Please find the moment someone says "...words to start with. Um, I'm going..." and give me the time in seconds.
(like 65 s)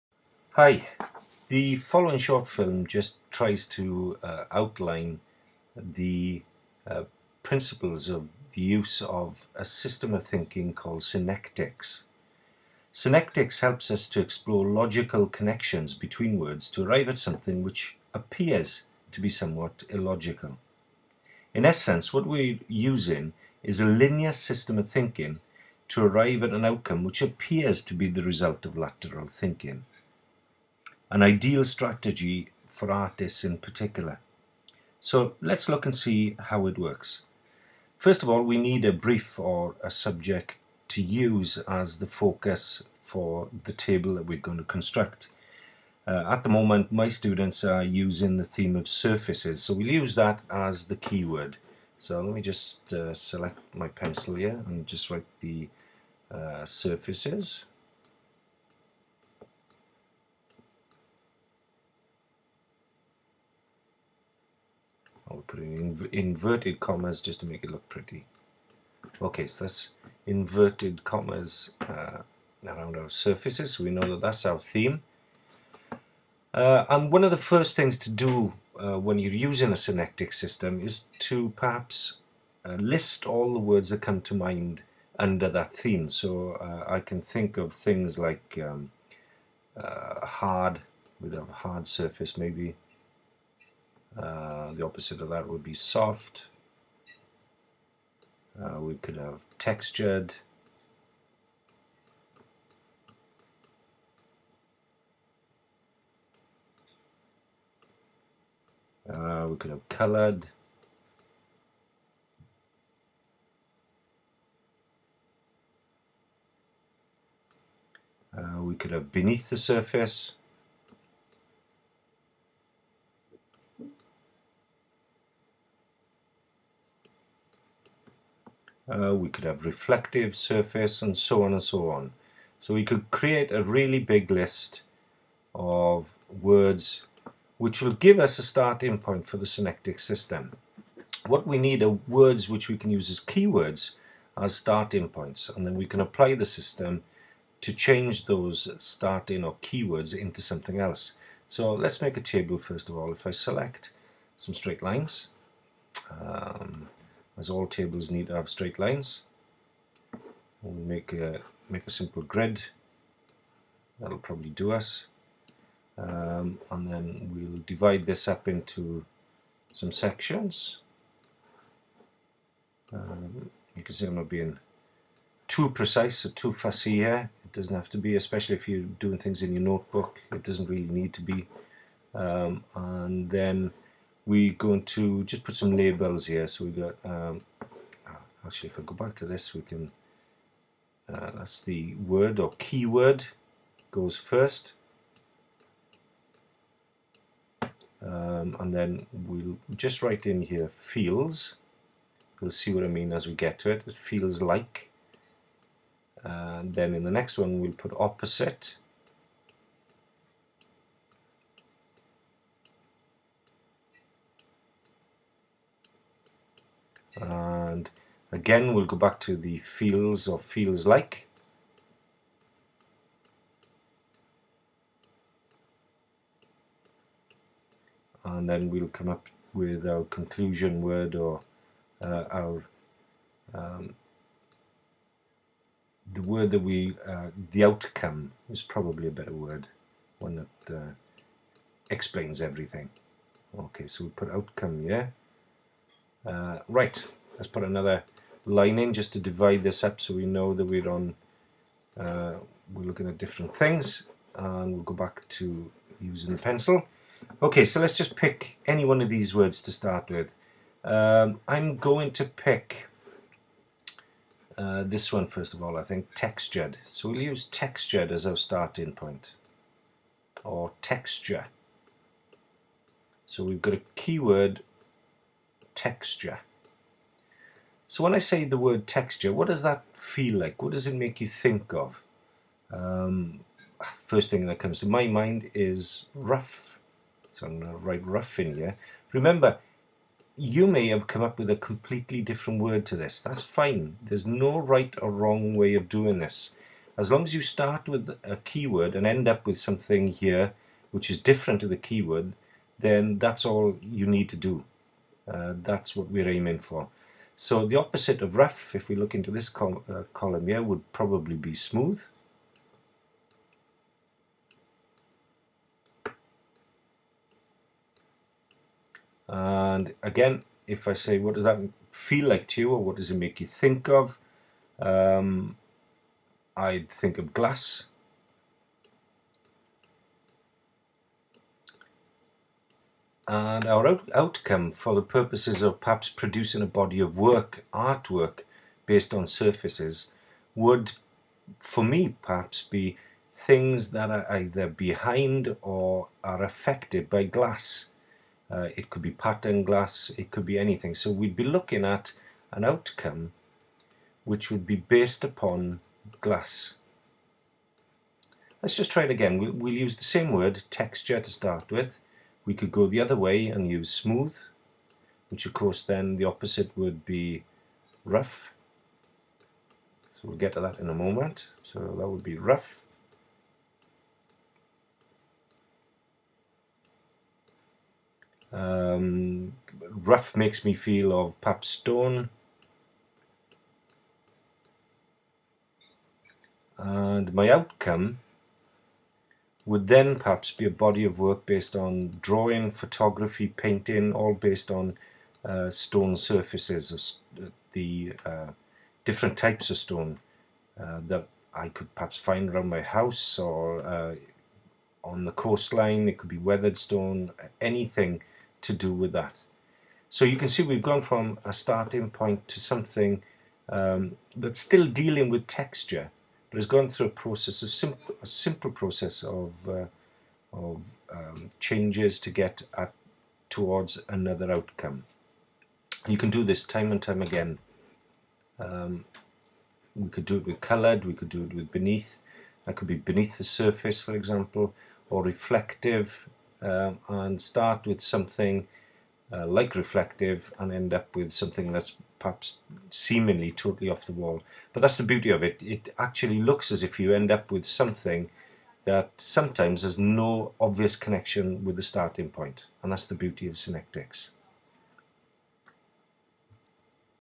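259 s.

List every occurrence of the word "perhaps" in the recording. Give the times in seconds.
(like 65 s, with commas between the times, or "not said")
81 s, 335 s, 342 s, 390 s, 401 s, 442 s.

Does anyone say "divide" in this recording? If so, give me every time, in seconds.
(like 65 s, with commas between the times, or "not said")
167 s, 249 s.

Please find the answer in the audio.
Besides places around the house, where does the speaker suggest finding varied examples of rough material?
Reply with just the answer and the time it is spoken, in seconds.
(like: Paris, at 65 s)
The coastline, at 405 s.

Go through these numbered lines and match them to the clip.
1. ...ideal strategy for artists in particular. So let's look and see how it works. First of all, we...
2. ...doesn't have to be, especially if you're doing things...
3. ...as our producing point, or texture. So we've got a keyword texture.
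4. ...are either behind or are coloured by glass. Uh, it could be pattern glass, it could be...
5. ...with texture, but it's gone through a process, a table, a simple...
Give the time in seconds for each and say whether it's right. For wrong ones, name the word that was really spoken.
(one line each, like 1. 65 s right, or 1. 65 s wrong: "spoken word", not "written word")
1. 31 s right
2. 177 s right
3. 268 s wrong: "starting", not "producing"
4. 344 s wrong: "affected", not "coloured"
5. 415 s wrong: "simple", not "table".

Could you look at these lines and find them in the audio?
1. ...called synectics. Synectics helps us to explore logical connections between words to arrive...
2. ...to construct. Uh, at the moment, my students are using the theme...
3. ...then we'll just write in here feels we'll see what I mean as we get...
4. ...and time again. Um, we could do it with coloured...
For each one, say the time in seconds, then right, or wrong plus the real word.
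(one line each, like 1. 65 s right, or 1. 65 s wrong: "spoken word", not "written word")
1. 10 s right
2. 44 s right
3. 198 s right
4. 426 s right.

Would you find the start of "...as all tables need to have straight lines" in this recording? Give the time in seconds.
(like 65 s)
157 s.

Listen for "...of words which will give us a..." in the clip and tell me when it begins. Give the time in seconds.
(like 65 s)
135 s.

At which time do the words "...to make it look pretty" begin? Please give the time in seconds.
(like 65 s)
67 s.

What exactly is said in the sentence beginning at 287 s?
So I'm going to write rough in here.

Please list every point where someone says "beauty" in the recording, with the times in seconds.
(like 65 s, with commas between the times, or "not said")
445 s, 453 s.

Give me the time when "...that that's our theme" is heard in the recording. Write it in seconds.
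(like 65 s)
74 s.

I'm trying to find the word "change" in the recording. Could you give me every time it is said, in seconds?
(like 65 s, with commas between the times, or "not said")
147 s, 421 s.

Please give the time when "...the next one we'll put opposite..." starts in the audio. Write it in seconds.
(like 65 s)
207 s.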